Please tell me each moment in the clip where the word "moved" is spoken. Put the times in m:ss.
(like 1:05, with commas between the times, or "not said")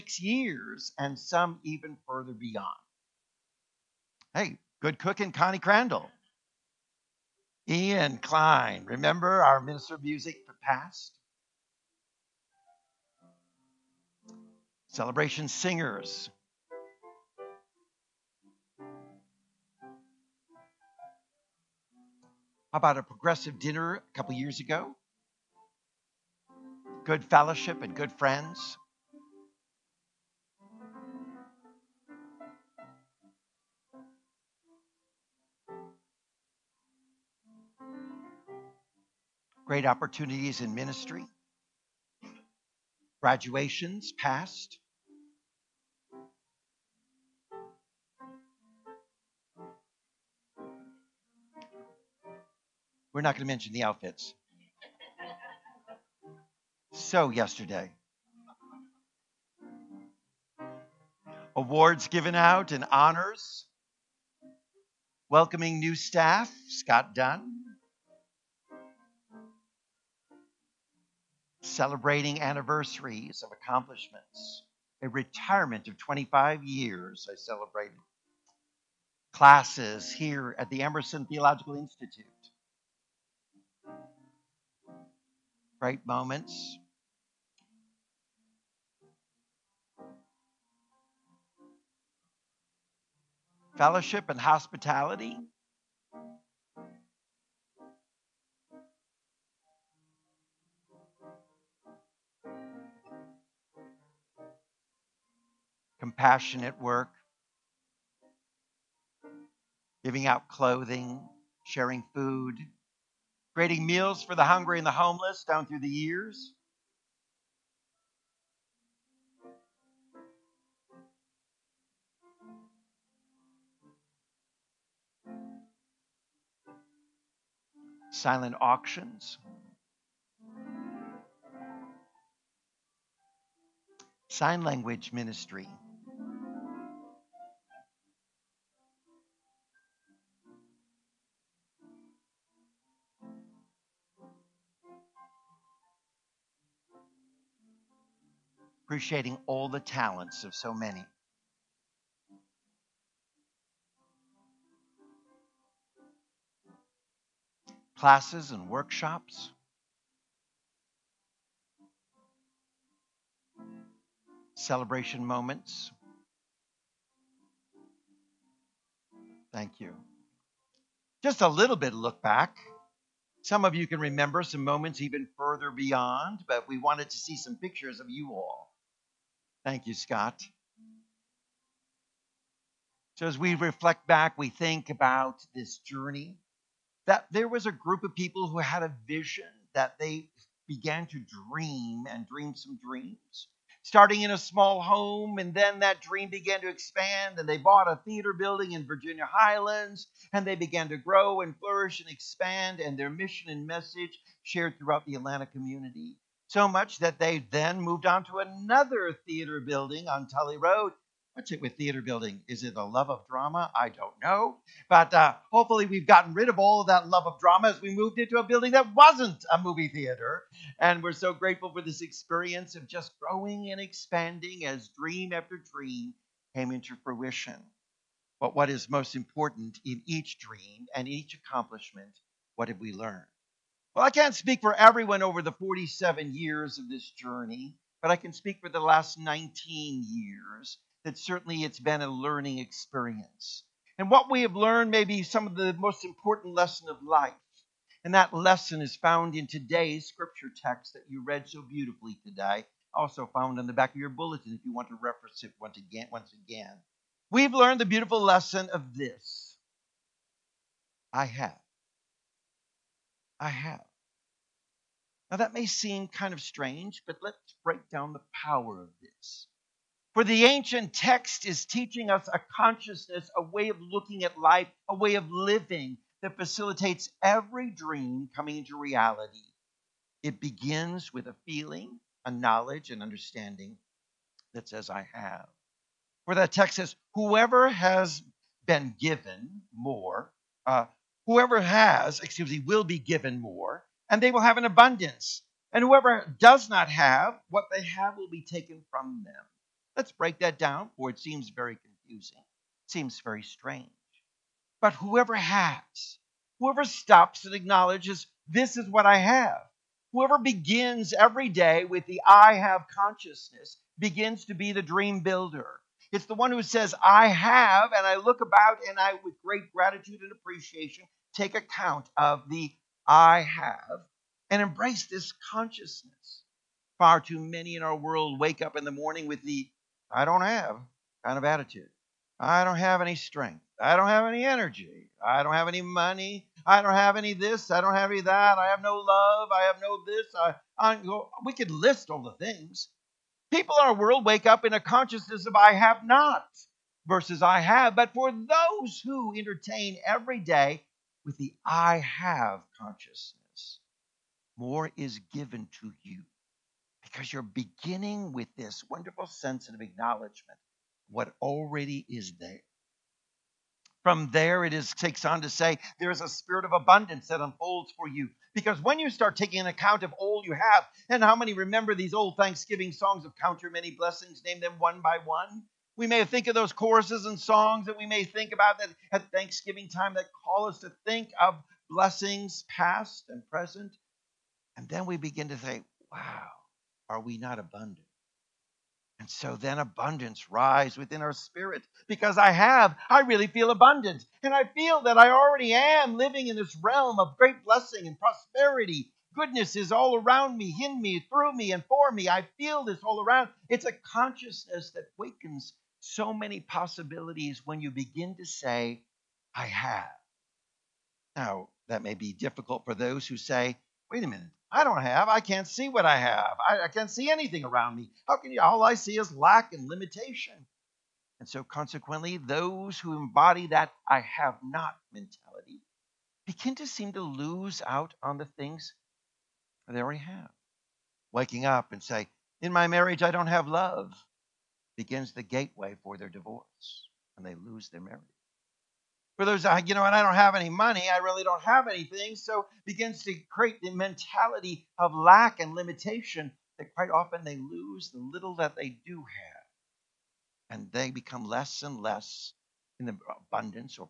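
3:27, 3:37.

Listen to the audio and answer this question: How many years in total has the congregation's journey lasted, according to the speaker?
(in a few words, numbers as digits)
47.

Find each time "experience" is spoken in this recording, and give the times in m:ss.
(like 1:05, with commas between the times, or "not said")
3:42, 4:02.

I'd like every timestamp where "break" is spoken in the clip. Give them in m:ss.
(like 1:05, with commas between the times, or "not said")
4:27, 5:00.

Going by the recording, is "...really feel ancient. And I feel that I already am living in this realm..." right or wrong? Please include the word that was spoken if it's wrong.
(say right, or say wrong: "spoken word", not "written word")
wrong: "abundant", not "ancient".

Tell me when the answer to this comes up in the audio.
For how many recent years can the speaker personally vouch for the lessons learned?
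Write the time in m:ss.
3:59.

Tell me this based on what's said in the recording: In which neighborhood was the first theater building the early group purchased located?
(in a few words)
Virginia Highlands.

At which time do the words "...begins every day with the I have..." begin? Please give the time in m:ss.
5:10.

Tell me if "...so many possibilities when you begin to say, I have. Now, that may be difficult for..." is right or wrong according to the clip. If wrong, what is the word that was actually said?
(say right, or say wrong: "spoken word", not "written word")
right.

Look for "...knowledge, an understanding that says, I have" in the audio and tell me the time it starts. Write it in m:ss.
4:42.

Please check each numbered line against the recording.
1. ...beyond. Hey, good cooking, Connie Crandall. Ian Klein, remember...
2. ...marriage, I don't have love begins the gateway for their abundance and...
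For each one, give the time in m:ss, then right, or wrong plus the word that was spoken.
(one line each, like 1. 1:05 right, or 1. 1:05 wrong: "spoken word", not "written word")
1. 0:02 right
2. 7:12 wrong: "divorce", not "abundance".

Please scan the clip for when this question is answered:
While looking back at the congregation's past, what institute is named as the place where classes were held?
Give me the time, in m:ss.
1:20.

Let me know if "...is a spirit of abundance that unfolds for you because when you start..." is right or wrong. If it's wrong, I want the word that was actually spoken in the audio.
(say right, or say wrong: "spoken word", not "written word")
right.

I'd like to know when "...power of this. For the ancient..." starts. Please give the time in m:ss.
4:28.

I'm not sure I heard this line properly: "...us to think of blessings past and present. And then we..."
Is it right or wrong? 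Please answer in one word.
right.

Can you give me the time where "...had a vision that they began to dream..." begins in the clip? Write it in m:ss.
3:08.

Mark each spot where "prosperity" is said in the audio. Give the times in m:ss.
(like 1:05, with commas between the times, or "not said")
6:38.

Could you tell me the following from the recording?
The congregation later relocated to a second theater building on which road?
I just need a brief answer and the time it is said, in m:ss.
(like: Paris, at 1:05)
Tullie Road, at 3:30.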